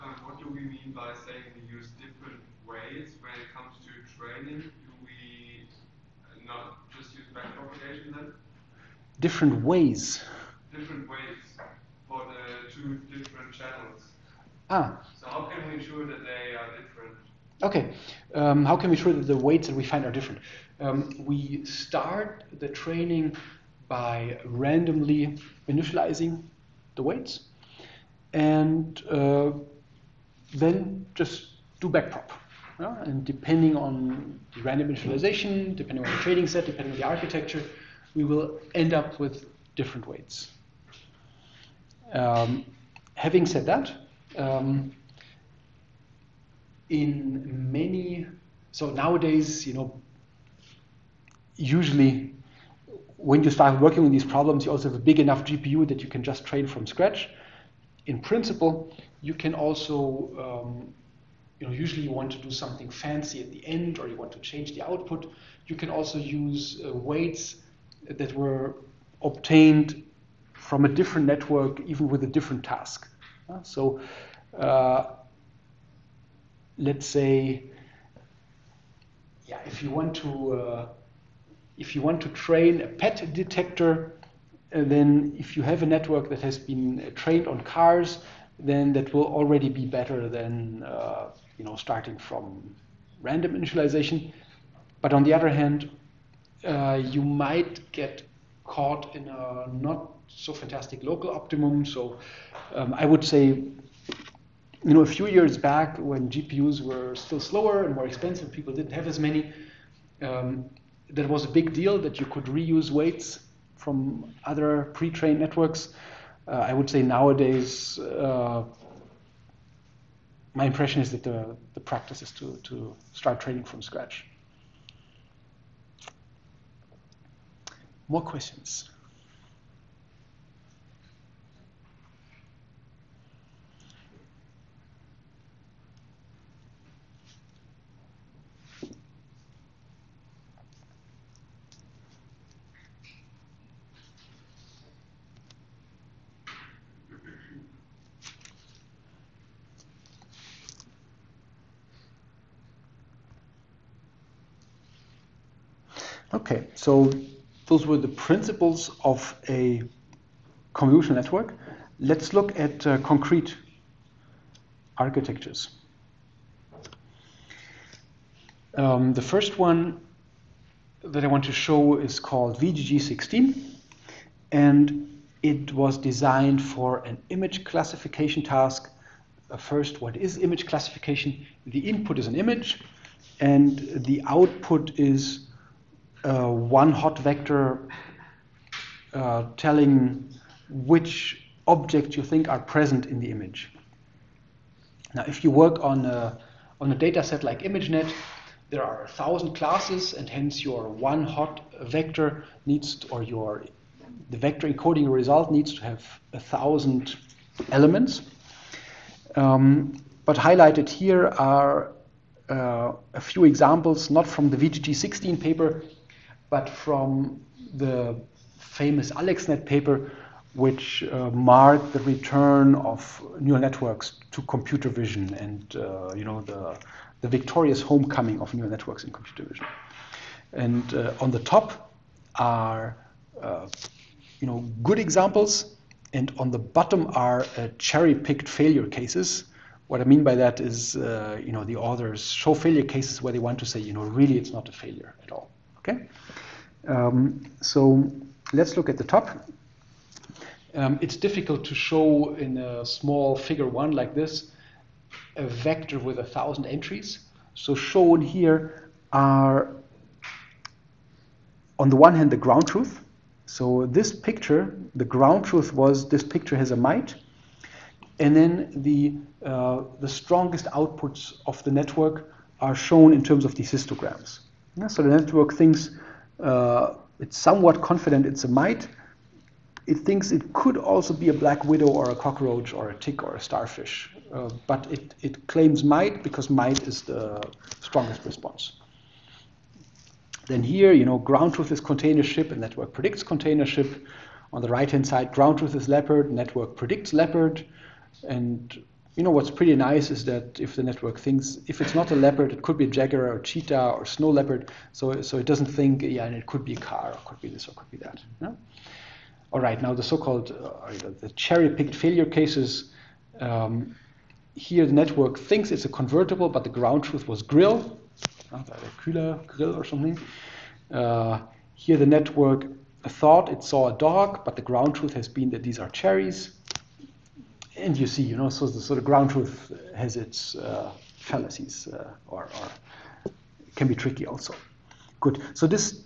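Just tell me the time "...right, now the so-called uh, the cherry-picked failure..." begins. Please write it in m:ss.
5:09.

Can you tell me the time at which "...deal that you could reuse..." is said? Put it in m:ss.
1:51.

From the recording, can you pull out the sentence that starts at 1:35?
But on the other hand, uh, you might get caught in a not so fantastic local optimum.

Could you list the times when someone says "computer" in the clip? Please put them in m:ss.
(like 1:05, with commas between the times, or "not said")
3:44, 3:49.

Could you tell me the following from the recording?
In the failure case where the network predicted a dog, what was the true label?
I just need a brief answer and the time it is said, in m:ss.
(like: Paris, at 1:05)
cherries, at 5:25.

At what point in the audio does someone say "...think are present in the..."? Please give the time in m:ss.
3:12.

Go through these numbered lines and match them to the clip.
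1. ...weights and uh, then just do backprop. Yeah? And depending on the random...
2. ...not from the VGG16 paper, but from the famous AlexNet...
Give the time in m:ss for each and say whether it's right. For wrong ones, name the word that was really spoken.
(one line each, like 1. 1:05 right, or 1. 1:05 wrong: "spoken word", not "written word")
1. 0:27 right
2. 3:34 right.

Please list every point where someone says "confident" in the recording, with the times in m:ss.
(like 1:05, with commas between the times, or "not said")
4:37.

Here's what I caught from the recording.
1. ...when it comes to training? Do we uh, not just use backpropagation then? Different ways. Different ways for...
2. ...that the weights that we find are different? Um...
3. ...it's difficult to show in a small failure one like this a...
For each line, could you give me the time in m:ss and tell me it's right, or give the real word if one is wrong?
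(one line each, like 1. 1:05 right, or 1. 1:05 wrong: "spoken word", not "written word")
1. 0:03 right
2. 0:19 right
3. 4:11 wrong: "figure", not "failure".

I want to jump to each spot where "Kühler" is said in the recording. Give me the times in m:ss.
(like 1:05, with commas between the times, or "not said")
5:19.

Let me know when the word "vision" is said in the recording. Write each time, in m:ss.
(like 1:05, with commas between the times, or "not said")
3:44, 3:49.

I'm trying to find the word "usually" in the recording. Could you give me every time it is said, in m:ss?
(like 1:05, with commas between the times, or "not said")
0:51, 1:01.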